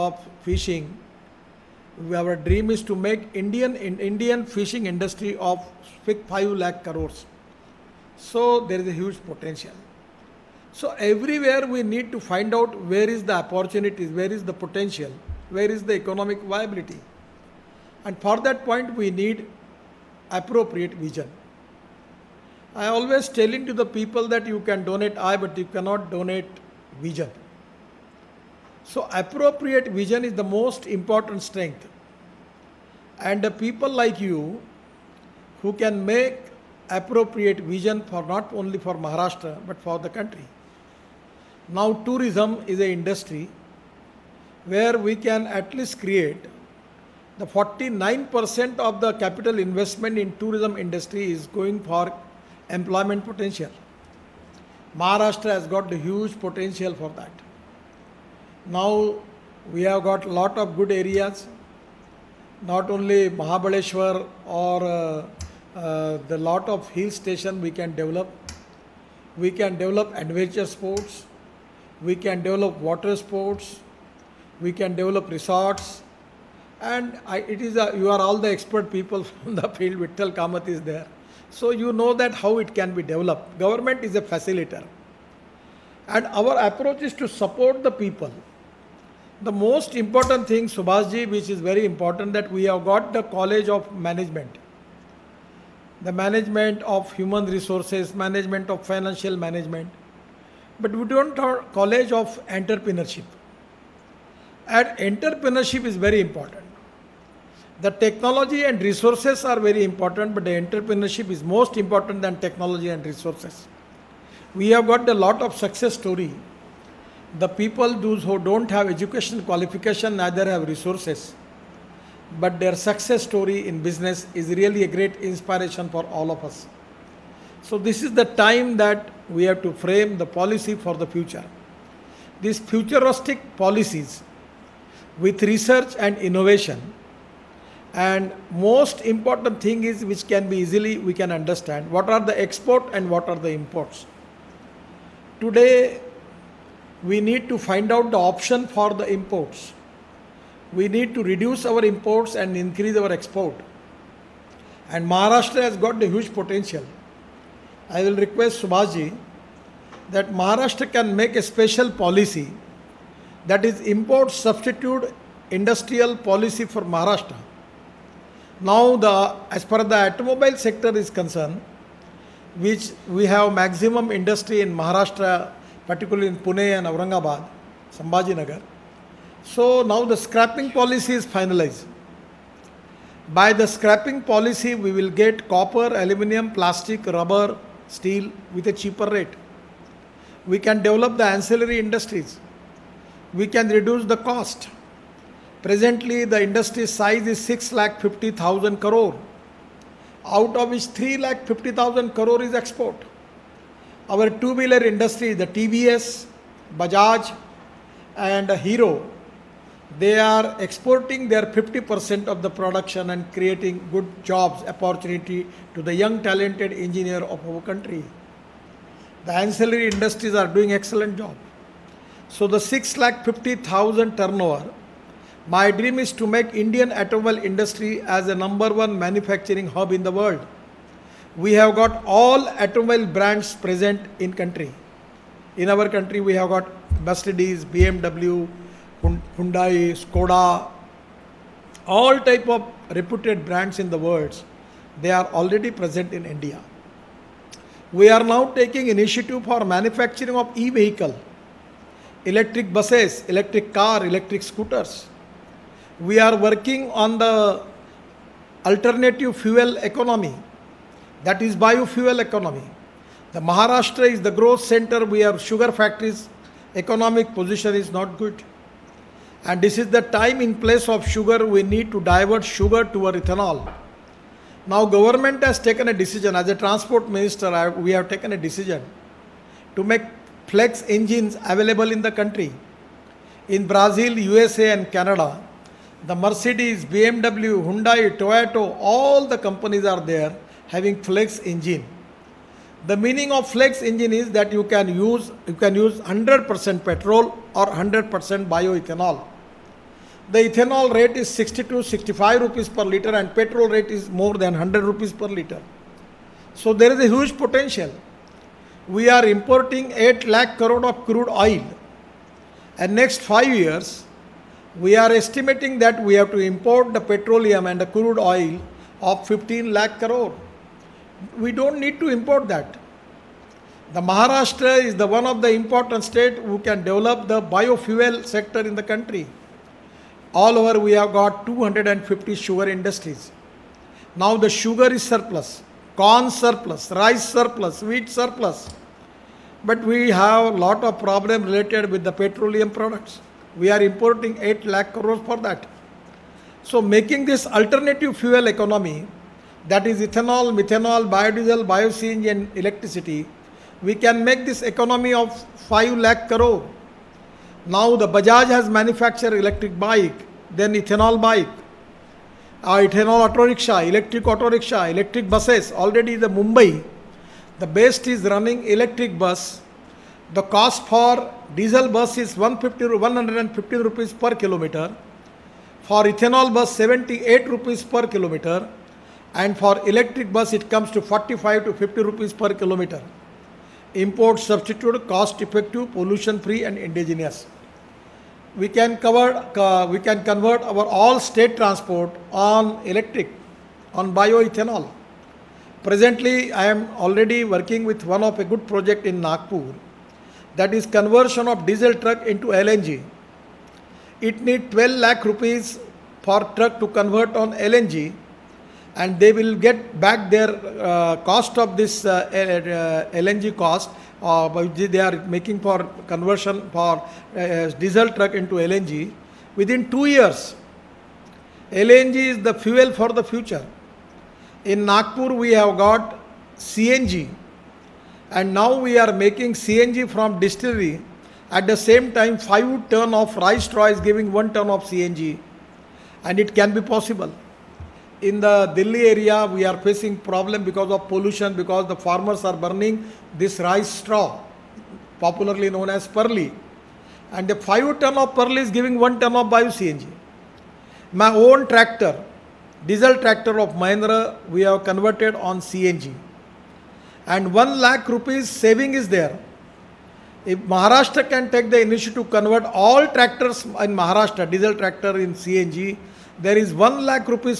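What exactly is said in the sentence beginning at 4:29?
And this is the time in place of sugar, we need to divert sugar our ethanol.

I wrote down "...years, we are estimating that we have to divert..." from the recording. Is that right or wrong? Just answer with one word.
wrong.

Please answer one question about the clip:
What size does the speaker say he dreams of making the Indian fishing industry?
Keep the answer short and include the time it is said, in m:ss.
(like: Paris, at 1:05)
5 lakh crores, at 0:06.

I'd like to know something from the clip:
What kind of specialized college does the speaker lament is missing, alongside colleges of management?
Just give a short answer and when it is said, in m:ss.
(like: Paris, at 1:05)
college of entrepreneurship, at 1:41.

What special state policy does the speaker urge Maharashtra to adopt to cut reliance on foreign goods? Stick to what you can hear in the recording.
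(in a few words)
import substitute industrial policy.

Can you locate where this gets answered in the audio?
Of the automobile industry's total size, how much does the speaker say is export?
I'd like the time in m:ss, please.
3:20.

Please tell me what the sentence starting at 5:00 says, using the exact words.
The ethanol rate is 62 65 rupees per liter and petrol rate is more than 100 rupees per liter.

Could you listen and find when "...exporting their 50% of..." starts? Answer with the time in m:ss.
3:30.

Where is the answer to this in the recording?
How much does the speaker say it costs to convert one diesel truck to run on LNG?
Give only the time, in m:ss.
6:44.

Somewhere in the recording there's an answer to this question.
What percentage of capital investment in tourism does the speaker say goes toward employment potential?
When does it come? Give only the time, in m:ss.
0:47.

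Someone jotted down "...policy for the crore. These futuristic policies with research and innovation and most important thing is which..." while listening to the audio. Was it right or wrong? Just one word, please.
wrong.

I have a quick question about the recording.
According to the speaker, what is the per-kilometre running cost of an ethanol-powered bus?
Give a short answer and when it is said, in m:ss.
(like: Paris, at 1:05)
78 rupees, at 6:16.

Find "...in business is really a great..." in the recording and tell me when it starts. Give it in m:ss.
2:03.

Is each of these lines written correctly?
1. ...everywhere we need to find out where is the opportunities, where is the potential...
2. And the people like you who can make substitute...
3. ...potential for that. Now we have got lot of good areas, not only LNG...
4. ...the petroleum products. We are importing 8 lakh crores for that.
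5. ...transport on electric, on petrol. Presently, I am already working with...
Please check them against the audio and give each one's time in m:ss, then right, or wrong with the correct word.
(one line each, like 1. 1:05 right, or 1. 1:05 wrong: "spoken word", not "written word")
1. 0:10 right
2. 0:33 wrong: "appropriate", not "substitute"
3. 0:56 wrong: "Mahabaleshwar", not "LNG"
4. 5:42 right
5. 6:31 wrong: "bioethanol", not "petrol".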